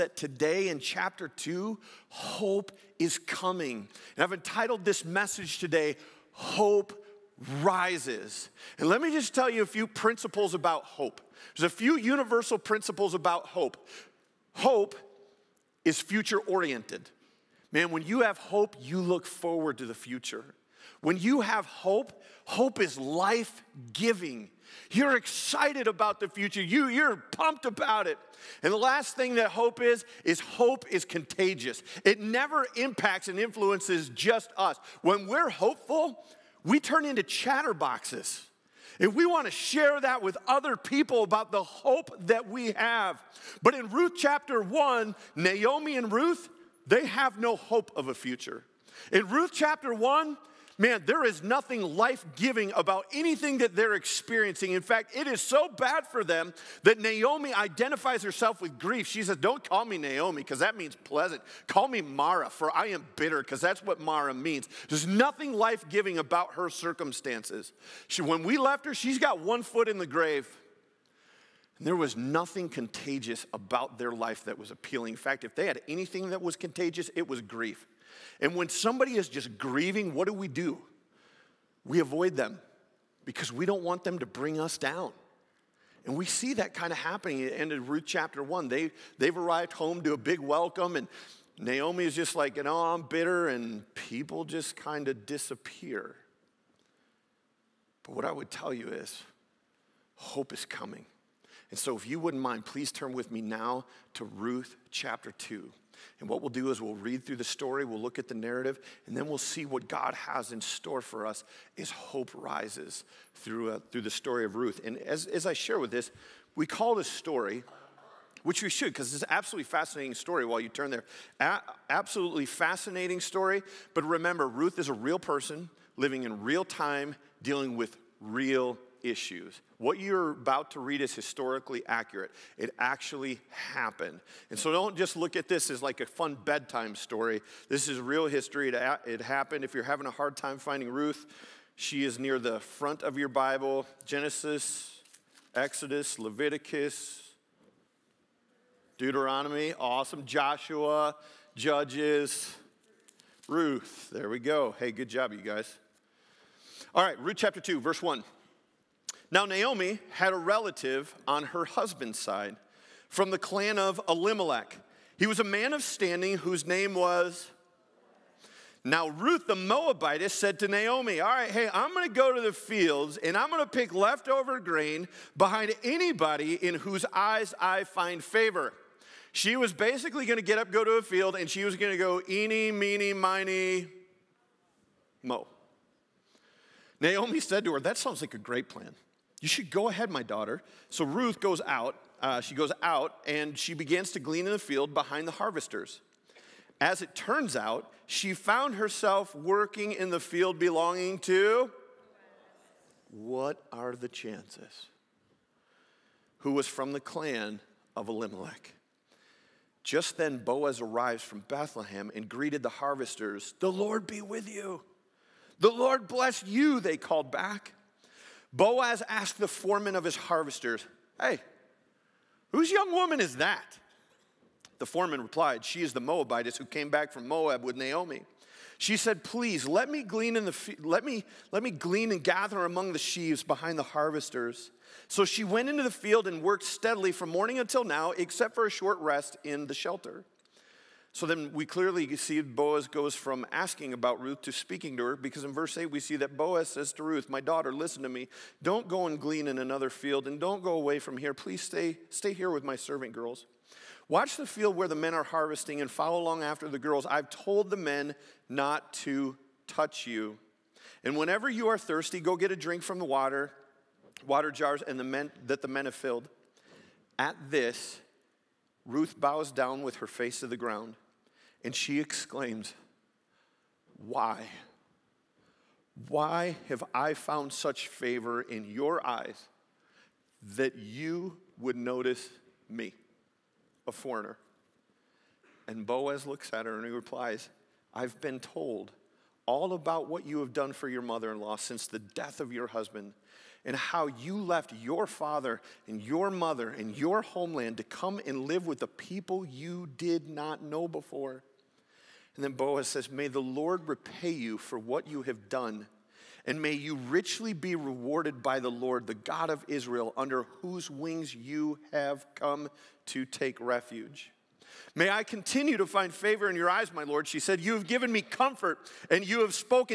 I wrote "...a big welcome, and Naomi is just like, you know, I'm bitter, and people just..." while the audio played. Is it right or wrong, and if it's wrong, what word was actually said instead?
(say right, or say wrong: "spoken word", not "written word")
right.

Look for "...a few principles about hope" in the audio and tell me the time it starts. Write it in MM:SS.
00:09.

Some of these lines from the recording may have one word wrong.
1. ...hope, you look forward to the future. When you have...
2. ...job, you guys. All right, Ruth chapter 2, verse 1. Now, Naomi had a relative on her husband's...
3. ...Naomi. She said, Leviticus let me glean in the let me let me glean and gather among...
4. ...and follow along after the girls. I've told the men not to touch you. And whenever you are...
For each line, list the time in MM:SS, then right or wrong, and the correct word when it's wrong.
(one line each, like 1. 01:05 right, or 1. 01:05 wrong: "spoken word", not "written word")
1. 00:18 right
2. 02:35 right
3. 03:47 wrong: "Please", not "Leviticus"
4. 04:15 right.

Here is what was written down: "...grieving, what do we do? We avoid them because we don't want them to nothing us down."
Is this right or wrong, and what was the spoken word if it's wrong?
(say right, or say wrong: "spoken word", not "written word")
wrong: "bring", not "nothing".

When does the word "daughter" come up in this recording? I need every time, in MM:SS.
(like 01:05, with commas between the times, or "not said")
03:10, 04:07.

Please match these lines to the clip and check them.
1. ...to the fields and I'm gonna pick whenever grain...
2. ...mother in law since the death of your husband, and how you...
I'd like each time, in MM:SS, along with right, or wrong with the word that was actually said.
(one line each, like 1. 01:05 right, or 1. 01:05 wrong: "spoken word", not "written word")
1. 02:52 wrong: "leftover", not "whenever"
2. 04:51 right.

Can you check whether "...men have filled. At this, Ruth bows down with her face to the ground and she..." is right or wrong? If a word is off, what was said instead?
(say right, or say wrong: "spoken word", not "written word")
right.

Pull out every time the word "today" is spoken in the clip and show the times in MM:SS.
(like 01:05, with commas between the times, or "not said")
00:00, 00:05.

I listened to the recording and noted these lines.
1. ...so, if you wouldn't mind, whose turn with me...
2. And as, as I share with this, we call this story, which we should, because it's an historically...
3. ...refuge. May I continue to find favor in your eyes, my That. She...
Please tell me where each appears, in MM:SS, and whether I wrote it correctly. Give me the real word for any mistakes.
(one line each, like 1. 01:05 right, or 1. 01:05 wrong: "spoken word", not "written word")
1. 01:41 wrong: "please", not "whose"
2. 01:54 wrong: "absolutely", not "historically"
3. 05:13 wrong: "Lord", not "That".